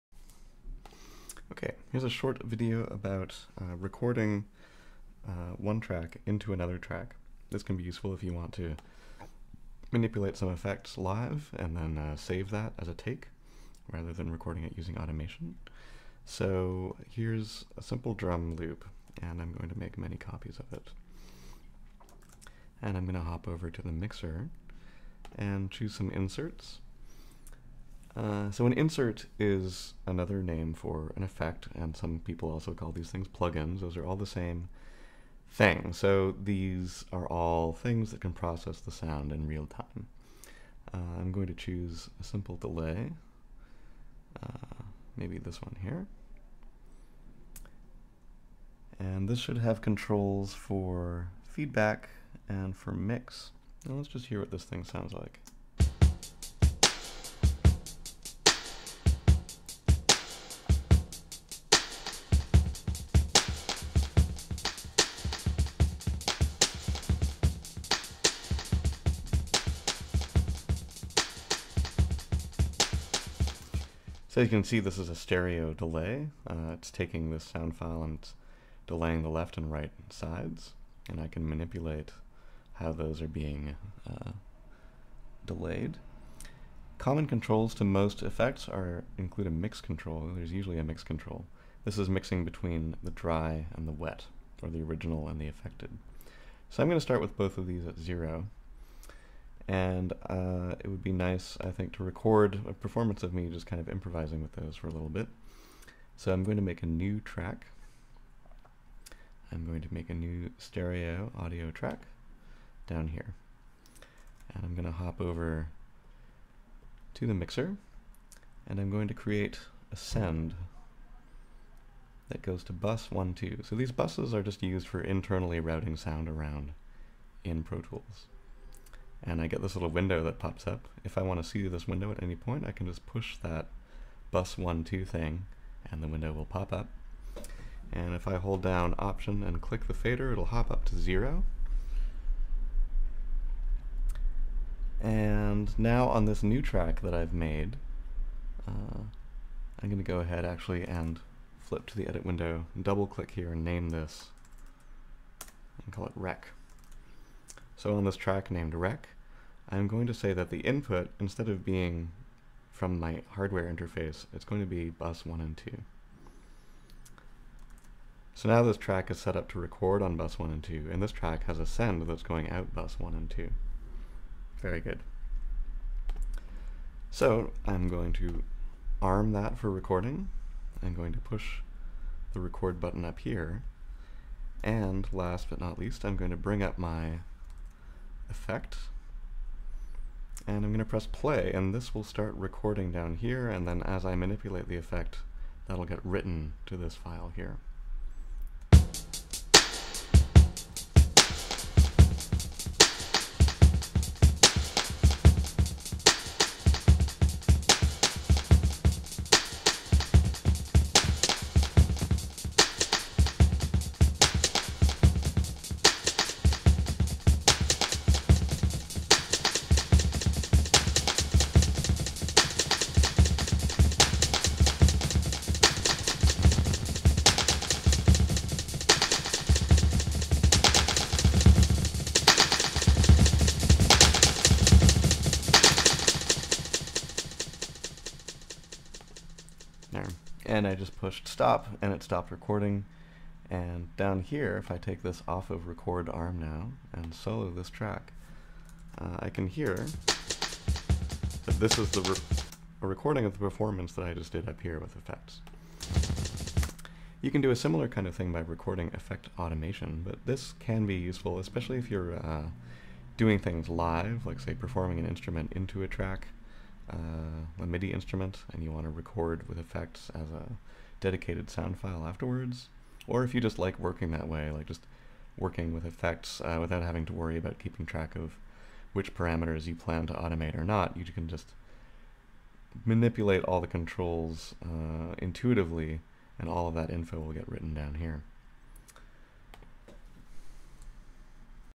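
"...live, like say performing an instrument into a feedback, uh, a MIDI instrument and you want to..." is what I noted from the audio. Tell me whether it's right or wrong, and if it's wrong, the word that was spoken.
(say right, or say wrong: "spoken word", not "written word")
wrong: "track", not "feedback".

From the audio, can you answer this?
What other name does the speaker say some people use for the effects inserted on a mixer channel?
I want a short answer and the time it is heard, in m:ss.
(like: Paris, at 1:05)
plugins, at 0:33.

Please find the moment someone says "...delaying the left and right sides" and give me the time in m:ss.
1:18.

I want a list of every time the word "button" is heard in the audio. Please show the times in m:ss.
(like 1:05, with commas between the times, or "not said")
3:02.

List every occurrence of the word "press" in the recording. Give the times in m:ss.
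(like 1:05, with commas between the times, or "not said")
3:10.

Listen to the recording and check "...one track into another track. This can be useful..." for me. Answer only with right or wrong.
right.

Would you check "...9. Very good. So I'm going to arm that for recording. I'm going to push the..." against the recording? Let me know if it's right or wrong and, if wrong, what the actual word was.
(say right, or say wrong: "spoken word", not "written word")
wrong: "2", not "9".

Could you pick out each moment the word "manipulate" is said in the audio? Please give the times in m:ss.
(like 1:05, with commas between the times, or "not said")
0:09, 1:21, 3:14, 4:42.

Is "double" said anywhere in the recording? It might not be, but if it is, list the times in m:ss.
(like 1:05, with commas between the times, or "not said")
2:32.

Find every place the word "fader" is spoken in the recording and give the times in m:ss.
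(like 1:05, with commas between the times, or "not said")
2:19.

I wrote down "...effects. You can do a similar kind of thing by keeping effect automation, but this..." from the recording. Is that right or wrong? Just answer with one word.
wrong.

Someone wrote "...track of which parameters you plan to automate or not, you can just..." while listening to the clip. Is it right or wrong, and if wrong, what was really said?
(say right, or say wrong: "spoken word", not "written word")
right.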